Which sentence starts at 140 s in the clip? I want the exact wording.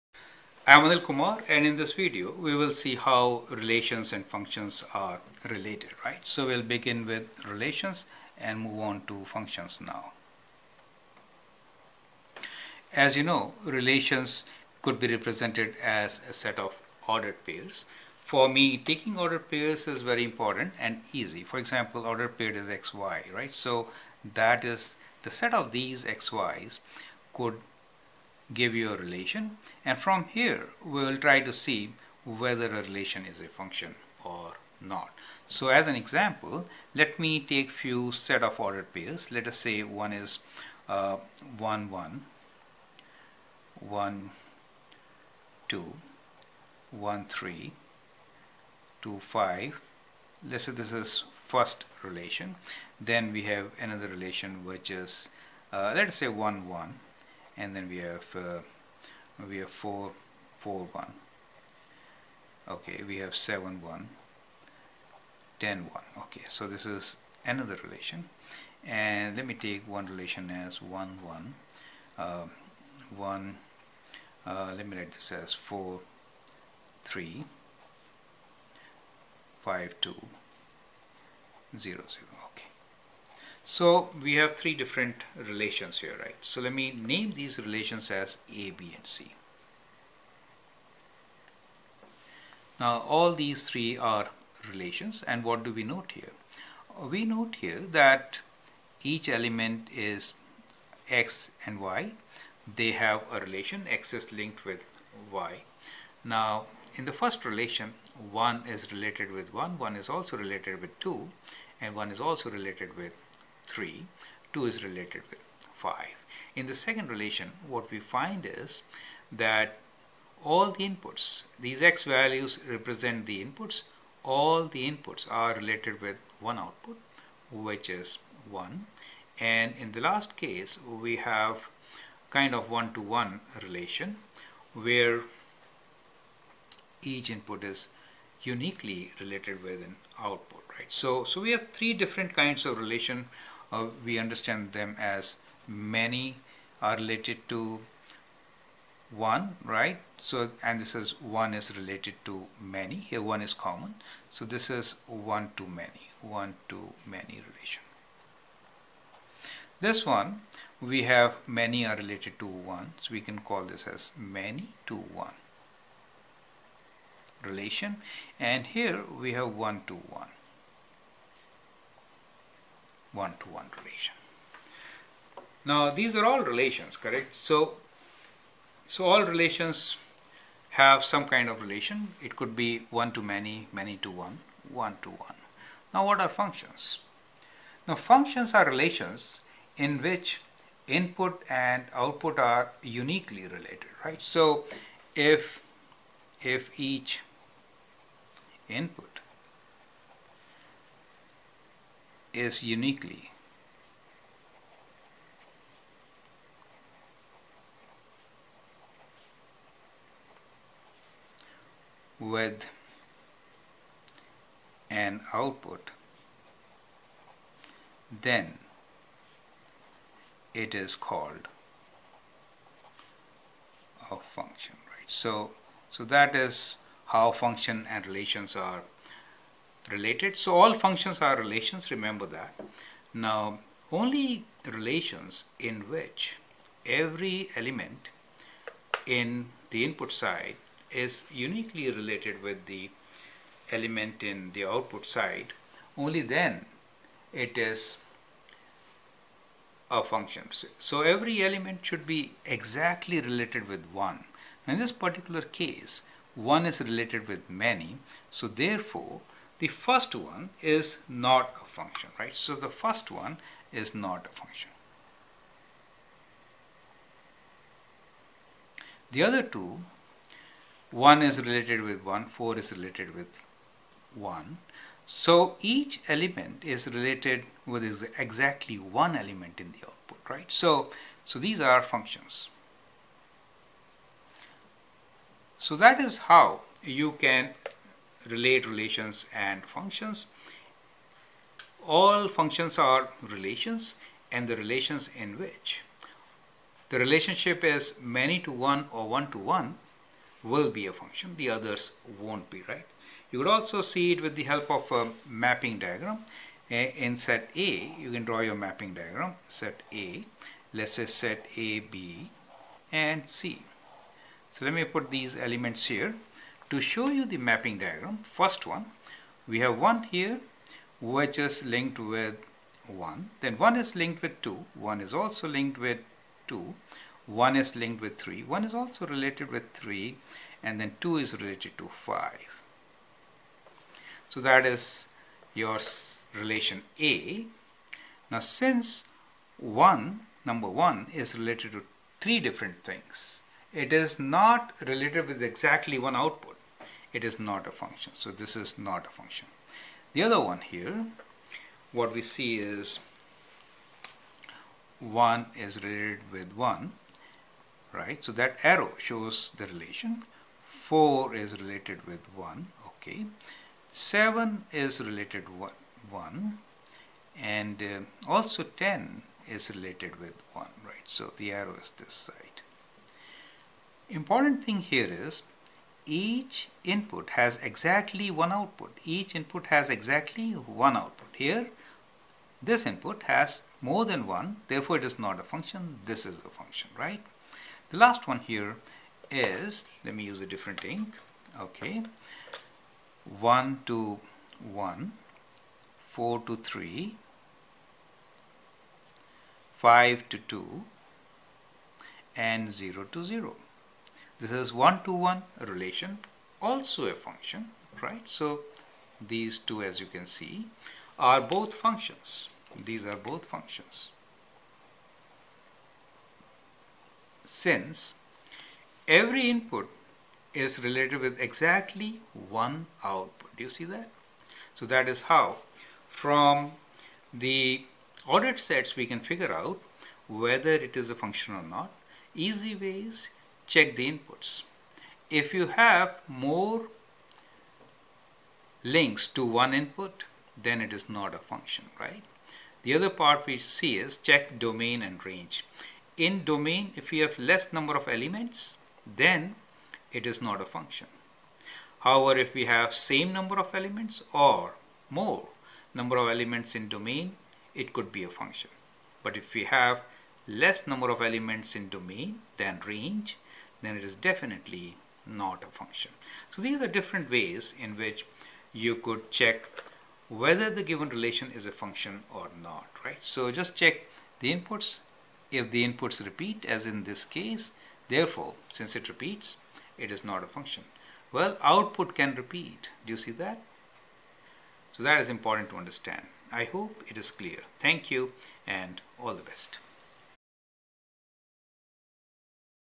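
So, so we have three different kinds of relation uh, we understand them as many are related to one, right?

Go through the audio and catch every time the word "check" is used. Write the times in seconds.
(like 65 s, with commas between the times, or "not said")
433 s, 444 s, 469 s, 473 s.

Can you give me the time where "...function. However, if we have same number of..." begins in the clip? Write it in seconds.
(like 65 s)
450 s.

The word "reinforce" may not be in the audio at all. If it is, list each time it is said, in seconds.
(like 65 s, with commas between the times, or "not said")
not said.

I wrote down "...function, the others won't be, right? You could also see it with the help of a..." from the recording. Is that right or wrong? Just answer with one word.
right.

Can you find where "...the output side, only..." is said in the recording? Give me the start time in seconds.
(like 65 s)
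244 s.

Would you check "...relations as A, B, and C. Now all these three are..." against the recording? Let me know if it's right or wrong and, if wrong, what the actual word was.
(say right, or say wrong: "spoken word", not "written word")
right.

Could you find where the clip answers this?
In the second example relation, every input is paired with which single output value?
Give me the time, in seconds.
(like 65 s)
127 s.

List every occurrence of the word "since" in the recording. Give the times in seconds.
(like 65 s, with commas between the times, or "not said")
338 s, 417 s, 478 s.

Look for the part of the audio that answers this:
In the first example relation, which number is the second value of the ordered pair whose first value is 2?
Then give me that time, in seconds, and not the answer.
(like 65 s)
49 s.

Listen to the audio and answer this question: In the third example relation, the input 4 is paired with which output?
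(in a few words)
3.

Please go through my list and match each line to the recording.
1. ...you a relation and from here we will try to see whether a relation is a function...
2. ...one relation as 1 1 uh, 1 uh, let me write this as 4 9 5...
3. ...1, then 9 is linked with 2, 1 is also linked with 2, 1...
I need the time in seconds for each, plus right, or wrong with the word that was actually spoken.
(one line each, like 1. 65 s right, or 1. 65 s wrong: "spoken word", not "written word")
1. 28 s right
2. 69 s wrong: "3", not "9"
3. 322 s wrong: "1", not "9".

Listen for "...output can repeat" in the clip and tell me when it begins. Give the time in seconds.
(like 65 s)
481 s.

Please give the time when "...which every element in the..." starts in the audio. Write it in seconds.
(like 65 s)
235 s.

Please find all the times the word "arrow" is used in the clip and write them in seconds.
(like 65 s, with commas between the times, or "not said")
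358 s, 371 s.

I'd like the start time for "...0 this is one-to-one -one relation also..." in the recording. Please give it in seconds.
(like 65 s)
403 s.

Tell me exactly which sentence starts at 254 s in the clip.
In this particular case, one is related with many, so therefore the first one is not a function, right?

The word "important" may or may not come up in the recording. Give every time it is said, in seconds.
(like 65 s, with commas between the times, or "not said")
20 s, 374 s, 485 s.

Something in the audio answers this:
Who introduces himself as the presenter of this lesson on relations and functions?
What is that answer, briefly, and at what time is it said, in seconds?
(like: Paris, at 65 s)
Anil Kumar, at 0 s.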